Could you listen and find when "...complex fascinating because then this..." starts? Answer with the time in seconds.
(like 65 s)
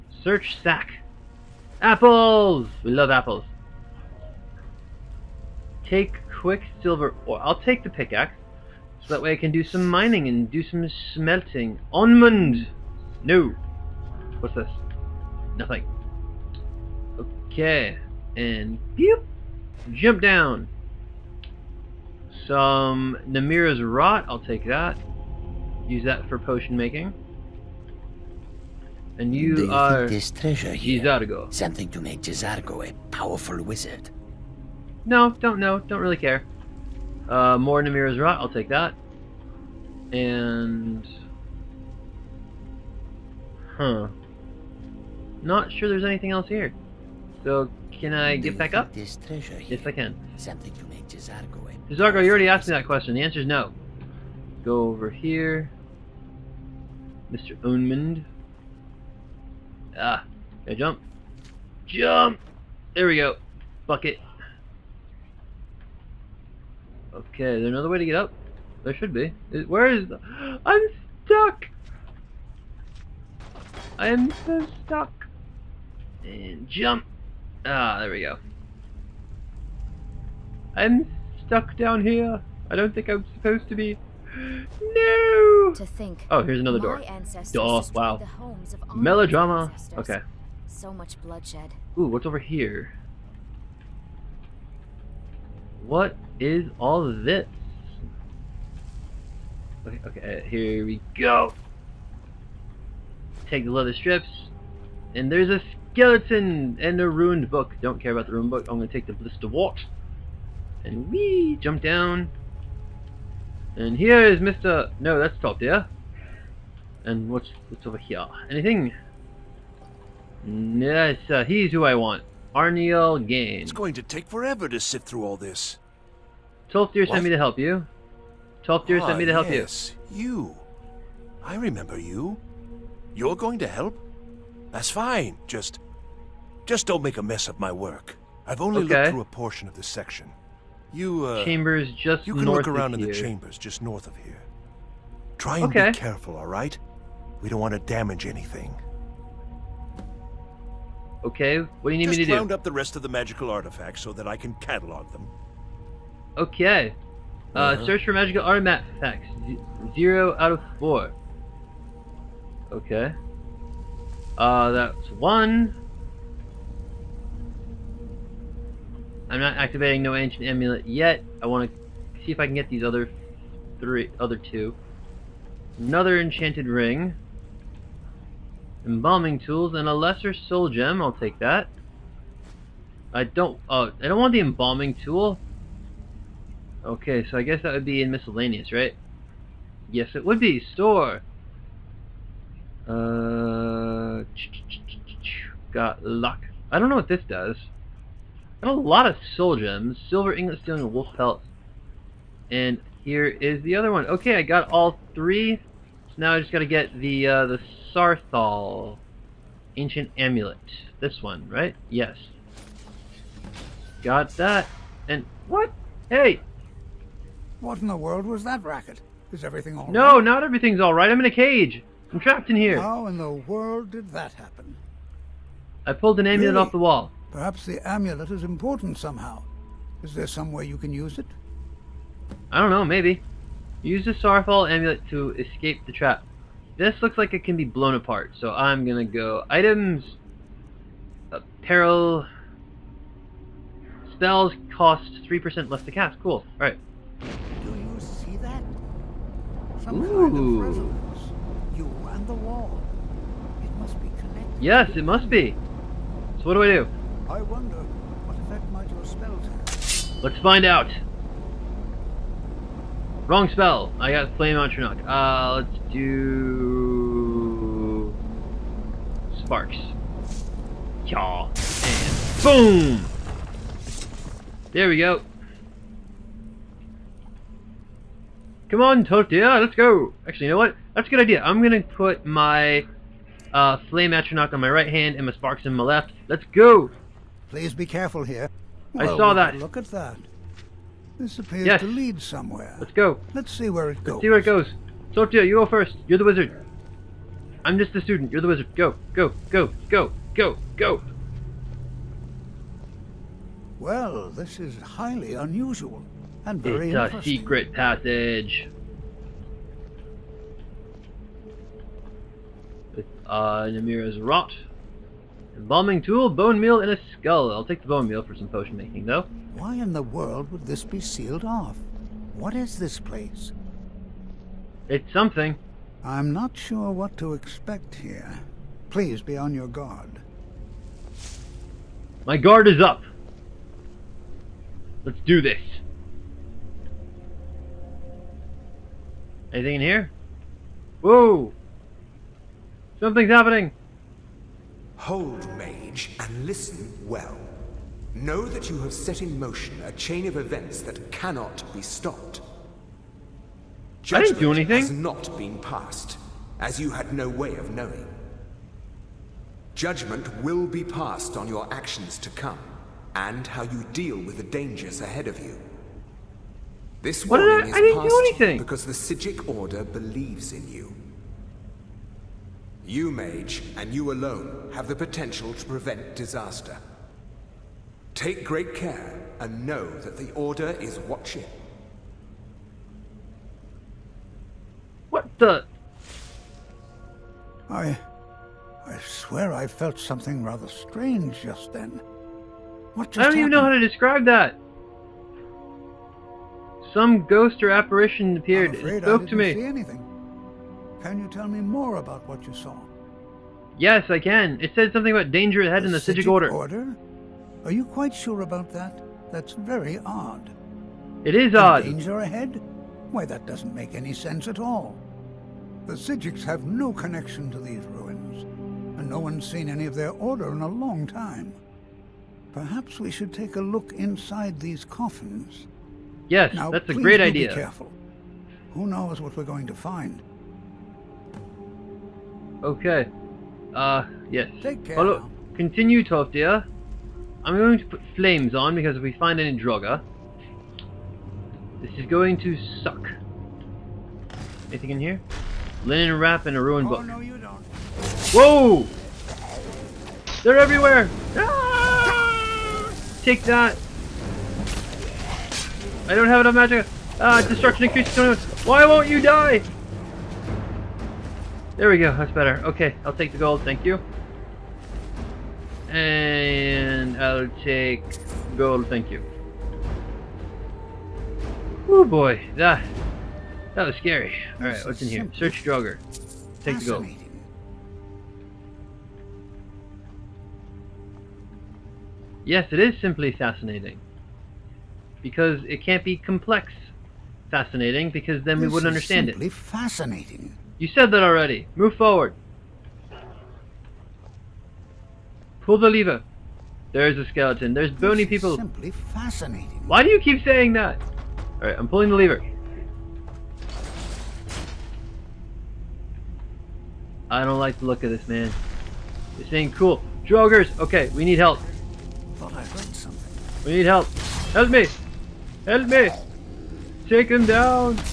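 486 s.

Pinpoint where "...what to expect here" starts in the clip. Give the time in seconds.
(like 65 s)
326 s.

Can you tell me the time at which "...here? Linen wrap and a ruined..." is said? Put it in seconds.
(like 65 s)
444 s.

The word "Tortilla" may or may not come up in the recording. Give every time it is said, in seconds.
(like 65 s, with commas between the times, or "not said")
279 s, 295 s.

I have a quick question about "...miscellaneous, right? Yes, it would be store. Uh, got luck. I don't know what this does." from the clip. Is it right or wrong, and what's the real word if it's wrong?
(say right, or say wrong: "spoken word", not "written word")
right.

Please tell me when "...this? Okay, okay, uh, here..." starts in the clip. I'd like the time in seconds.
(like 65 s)
97 s.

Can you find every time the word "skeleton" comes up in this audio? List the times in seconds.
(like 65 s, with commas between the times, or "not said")
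105 s, 497 s.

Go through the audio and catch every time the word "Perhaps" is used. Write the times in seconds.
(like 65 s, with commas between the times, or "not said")
227 s, 422 s.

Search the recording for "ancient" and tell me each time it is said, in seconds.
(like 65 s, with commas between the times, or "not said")
170 s, 209 s.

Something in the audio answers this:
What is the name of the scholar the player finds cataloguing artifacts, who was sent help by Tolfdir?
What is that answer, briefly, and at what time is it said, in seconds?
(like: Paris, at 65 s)
Arniel Gane, at 122 s.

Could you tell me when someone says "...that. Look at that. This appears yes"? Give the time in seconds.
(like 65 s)
289 s.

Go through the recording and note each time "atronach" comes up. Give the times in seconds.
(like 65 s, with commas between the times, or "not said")
264 s, 284 s.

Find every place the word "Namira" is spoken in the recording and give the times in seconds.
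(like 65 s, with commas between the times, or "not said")
23 s, 37 s, 313 s.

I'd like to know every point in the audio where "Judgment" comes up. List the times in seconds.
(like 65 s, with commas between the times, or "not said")
354 s, 359 s.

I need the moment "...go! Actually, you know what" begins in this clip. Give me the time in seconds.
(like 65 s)
279 s.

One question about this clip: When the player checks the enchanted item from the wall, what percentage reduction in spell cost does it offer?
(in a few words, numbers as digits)
3%.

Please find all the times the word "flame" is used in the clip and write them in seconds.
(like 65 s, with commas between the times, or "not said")
264 s, 283 s, 438 s.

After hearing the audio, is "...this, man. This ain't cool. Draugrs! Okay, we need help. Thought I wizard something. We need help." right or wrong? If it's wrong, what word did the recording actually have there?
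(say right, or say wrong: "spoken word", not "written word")
wrong: "heard", not "wizard".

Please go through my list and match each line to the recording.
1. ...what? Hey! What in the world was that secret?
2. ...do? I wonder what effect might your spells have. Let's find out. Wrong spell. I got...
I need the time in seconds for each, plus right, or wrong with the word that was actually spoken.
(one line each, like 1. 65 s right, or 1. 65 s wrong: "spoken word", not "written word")
1. 215 s wrong: "racket", not "secret"
2. 256 s right.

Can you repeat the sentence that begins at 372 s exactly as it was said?
You, Mage, and you alone have the potential to prevent disaster.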